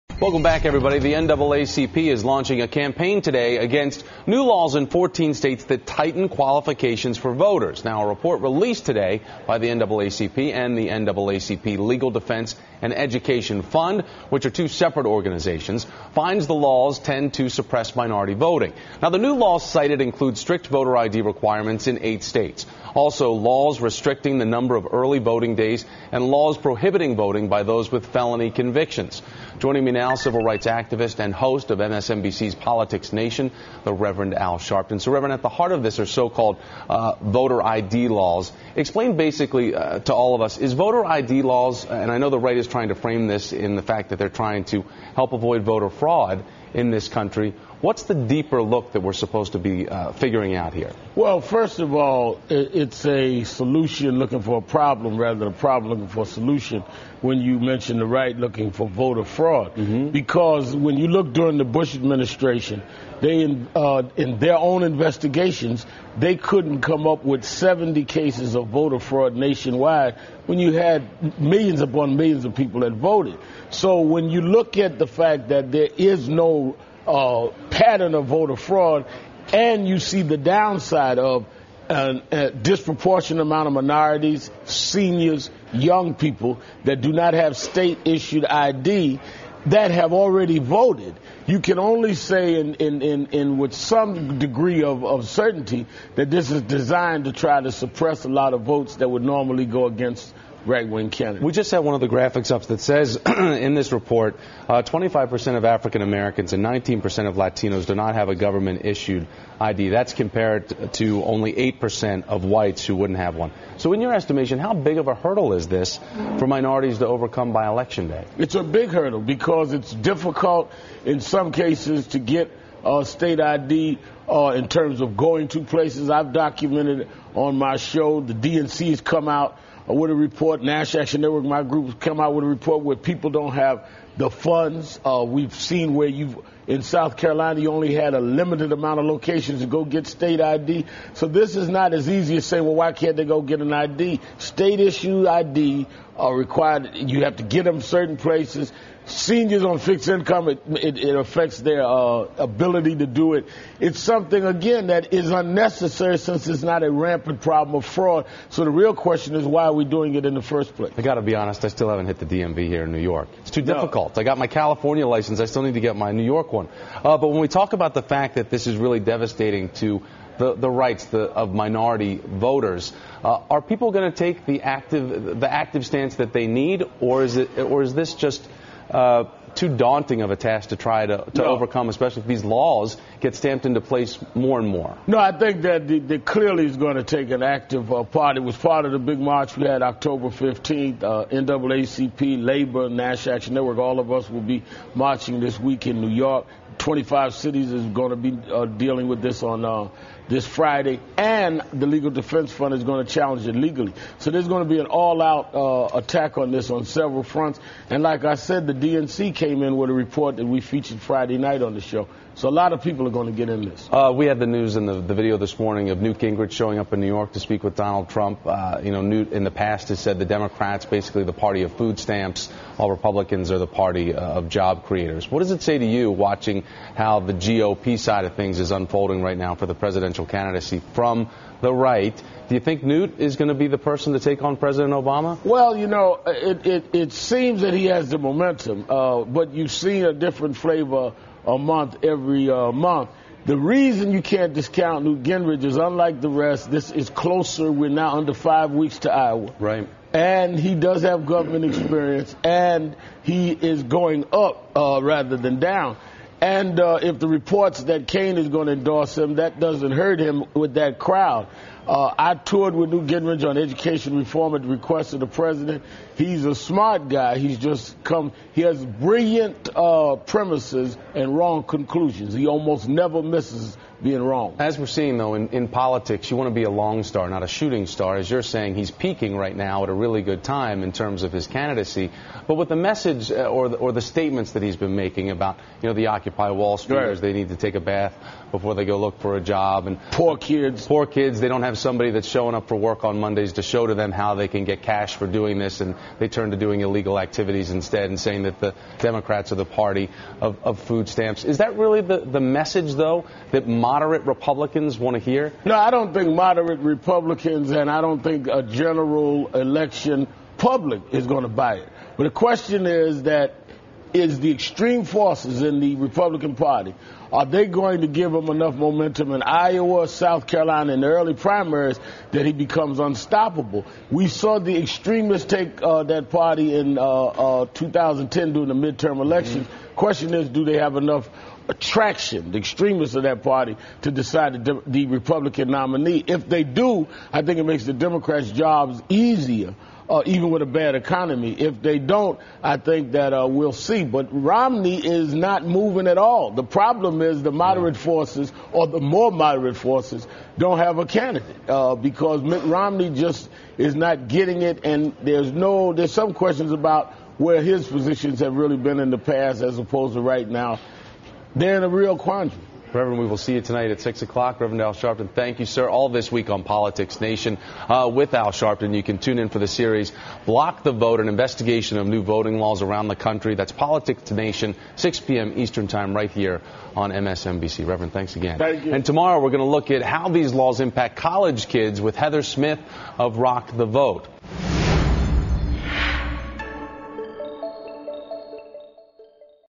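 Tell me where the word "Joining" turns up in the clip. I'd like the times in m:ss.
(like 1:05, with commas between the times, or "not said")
0:29.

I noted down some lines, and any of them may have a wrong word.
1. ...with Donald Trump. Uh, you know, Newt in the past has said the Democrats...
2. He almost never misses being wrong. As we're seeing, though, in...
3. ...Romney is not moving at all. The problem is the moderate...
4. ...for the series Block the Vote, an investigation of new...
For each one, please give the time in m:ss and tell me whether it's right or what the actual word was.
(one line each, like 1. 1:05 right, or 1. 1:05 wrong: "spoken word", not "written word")
1. 3:37 right
2. 4:32 right
3. 5:44 right
4. 6:09 right.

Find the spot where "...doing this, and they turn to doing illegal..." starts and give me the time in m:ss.
4:55.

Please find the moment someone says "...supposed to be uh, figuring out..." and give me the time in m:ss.
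0:49.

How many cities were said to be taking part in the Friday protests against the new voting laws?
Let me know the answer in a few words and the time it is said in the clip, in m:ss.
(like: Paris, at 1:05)
25, at 3:16.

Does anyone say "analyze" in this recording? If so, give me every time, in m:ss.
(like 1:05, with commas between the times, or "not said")
not said.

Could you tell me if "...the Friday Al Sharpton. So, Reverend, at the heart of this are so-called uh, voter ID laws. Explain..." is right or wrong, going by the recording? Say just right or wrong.
wrong.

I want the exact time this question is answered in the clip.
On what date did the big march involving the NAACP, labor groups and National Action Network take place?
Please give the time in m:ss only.
3:09.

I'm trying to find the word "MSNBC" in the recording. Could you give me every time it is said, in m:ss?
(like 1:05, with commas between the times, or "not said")
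0:31, 6:17.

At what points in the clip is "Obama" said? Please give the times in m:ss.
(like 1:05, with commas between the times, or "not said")
3:54.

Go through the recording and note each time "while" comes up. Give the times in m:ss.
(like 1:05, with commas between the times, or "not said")
3:42.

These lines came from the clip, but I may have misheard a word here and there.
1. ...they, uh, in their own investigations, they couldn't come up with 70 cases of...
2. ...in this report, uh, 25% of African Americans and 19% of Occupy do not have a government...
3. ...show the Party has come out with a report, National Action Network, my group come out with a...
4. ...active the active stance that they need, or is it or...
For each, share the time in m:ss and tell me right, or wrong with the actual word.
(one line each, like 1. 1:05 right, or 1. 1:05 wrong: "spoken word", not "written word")
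1. 1:03 right
2. 1:43 wrong: "Latinos", not "Occupy"
3. 2:07 wrong: "DNC", not "Party"
4. 2:54 right.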